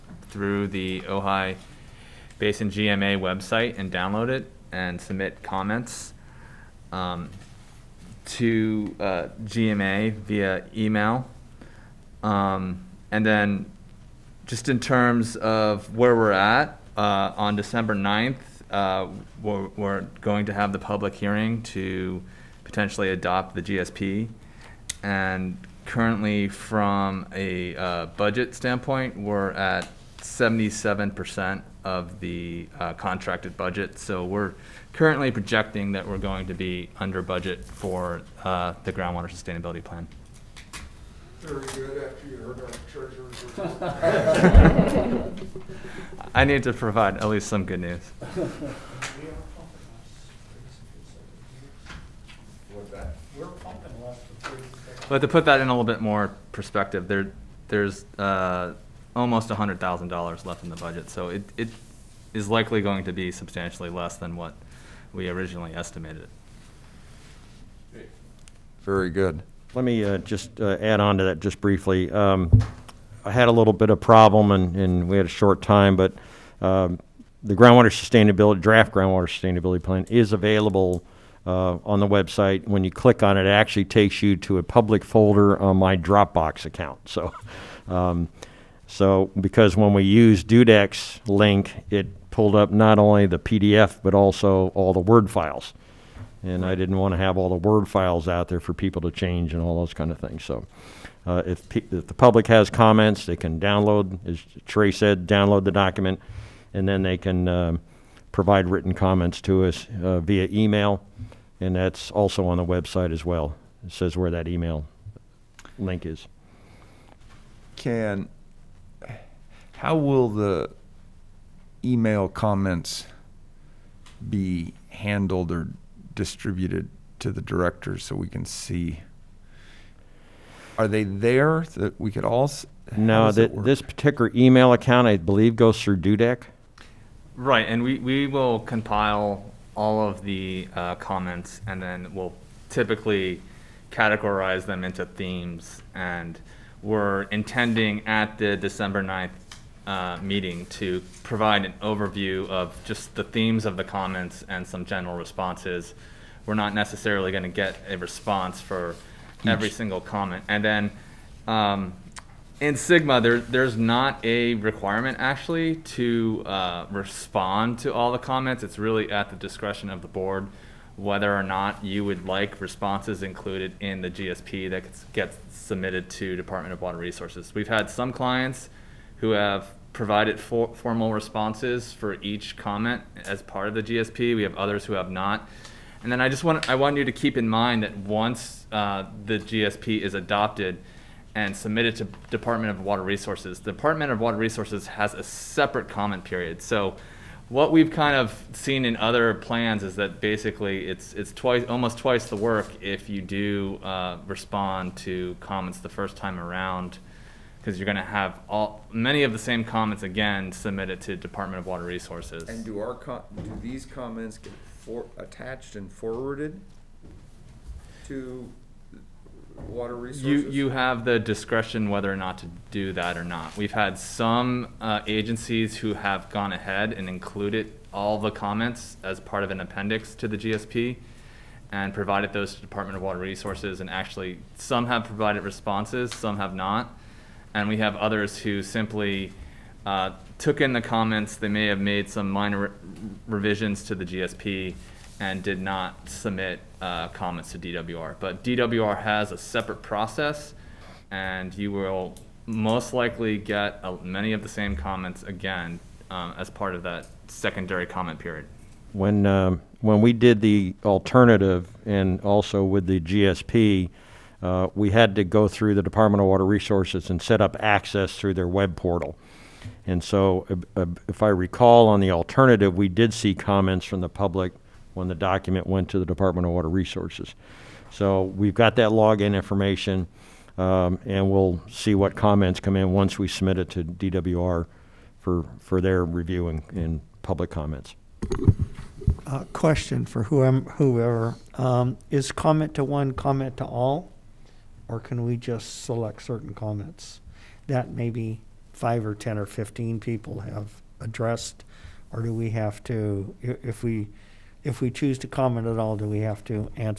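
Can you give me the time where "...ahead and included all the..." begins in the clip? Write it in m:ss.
3:46.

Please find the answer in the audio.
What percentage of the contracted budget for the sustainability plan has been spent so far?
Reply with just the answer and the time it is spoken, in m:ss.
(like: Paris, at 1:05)
77%, at 0:30.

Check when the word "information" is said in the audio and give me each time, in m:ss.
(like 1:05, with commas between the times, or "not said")
4:39.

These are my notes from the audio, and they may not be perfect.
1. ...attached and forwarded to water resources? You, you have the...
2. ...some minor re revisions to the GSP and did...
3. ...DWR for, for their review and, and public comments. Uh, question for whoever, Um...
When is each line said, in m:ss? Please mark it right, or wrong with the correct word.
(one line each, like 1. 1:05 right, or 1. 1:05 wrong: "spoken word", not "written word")
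1. 3:35 right
2. 4:02 right
3. 4:43 right.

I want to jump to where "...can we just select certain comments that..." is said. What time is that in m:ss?
4:54.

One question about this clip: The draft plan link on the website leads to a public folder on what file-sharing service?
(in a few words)
Dropbox.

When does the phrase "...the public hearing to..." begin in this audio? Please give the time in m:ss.
0:20.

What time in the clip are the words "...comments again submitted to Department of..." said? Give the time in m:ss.
3:29.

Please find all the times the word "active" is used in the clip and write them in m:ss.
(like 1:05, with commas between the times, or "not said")
not said.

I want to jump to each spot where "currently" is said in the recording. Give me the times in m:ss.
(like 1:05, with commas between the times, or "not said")
0:25, 0:34.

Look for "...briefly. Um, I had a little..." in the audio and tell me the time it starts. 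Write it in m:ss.
1:11.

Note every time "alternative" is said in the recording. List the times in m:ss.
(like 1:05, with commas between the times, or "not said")
4:20, 4:32.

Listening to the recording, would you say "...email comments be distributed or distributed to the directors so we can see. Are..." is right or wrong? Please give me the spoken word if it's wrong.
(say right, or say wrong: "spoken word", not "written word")
wrong: "handled", not "distributed".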